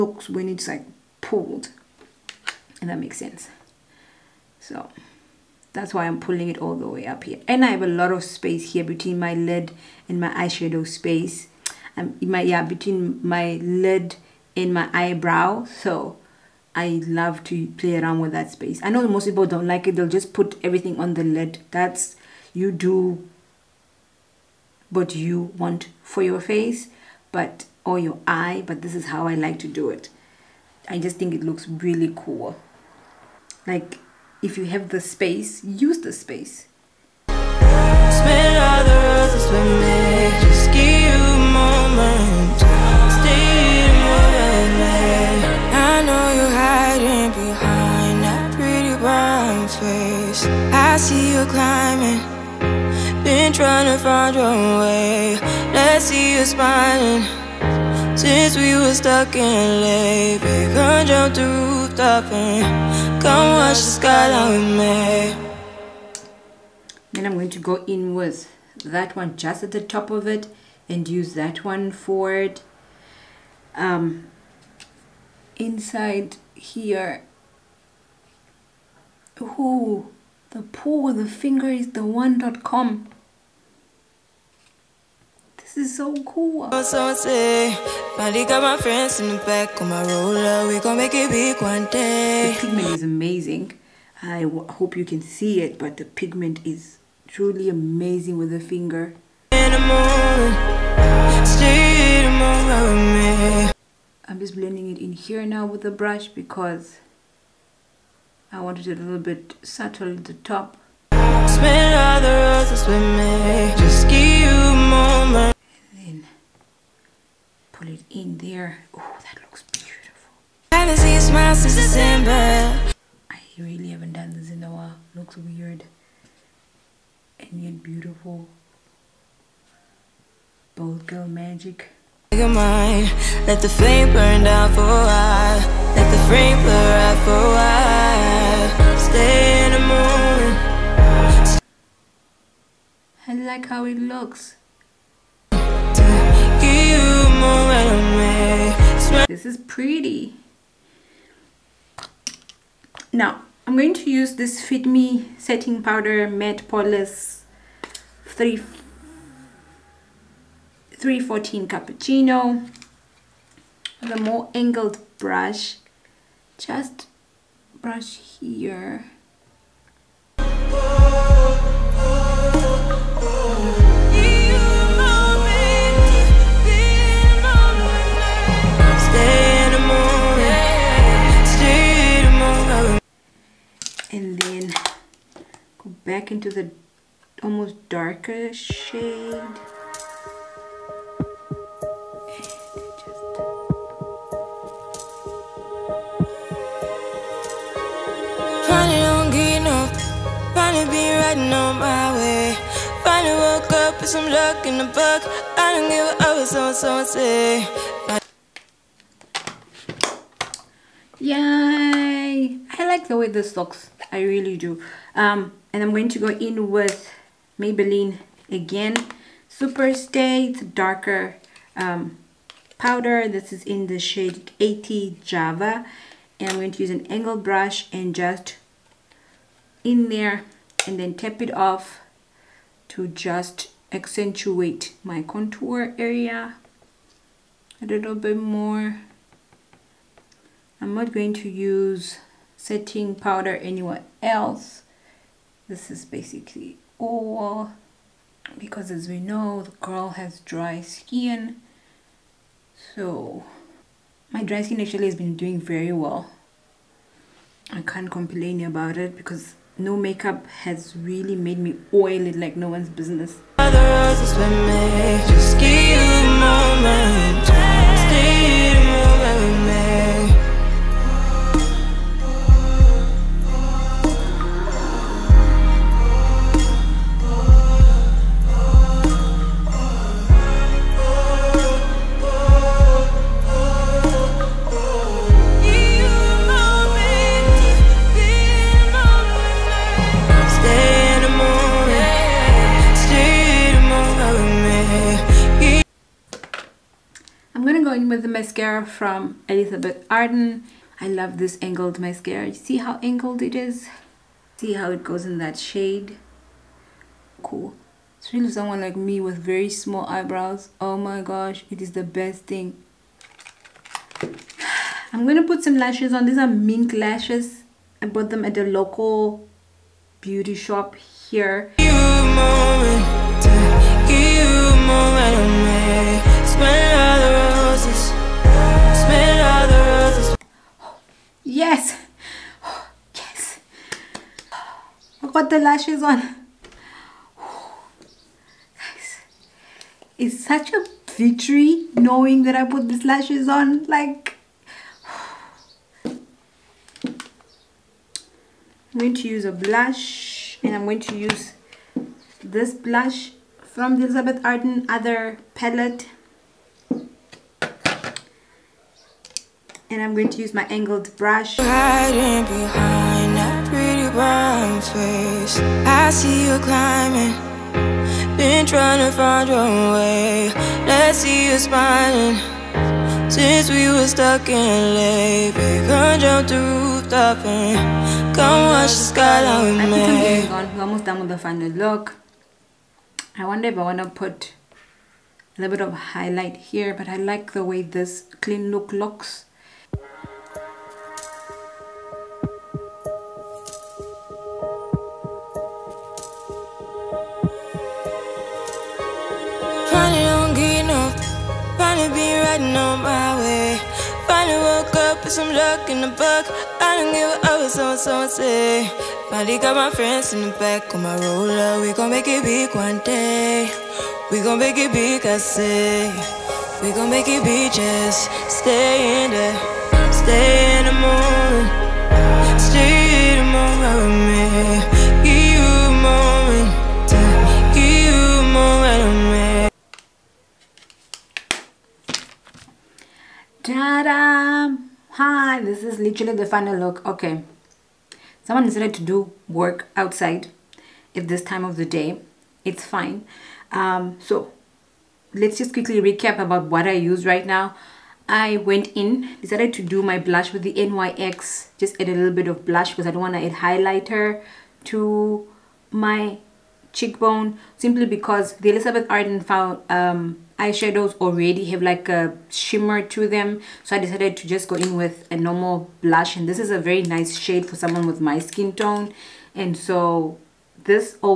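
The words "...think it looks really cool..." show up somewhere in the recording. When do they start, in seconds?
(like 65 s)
31 s.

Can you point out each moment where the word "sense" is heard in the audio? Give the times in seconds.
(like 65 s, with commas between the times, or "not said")
3 s.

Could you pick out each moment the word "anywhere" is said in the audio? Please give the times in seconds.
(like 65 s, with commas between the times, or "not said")
243 s.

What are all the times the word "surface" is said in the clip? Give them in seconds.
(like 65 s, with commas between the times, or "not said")
not said.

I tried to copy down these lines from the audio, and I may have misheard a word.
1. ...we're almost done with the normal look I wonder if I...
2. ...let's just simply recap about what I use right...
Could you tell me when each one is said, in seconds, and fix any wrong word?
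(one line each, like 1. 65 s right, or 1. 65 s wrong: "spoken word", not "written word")
1. 380 s wrong: "final", not "normal"
2. 445 s wrong: "quickly", not "simply".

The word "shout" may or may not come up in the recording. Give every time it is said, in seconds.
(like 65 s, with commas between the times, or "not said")
not said.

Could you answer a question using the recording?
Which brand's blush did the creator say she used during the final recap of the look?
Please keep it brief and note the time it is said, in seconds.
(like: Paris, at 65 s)
NYX, at 450 s.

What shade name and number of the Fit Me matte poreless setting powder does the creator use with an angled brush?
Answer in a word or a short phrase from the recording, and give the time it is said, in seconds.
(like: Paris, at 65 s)
314 Cappuccino, at 160 s.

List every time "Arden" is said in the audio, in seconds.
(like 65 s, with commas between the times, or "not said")
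300 s, 354 s, 459 s.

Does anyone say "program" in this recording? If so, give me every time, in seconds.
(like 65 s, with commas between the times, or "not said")
not said.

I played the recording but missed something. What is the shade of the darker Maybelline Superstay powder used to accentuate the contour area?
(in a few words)
80 Java.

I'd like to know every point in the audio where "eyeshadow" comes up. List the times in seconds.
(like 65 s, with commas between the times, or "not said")
10 s, 460 s.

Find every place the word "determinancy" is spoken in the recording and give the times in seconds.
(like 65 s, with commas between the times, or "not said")
not said.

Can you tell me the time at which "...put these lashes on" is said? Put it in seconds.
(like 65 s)
342 s.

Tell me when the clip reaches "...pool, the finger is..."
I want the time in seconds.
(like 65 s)
80 s.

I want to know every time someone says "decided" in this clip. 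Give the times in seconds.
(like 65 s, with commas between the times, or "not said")
438 s, 449 s, 463 s.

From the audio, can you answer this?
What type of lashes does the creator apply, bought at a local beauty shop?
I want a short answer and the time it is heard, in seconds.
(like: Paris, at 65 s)
Mink lashes, at 316 s.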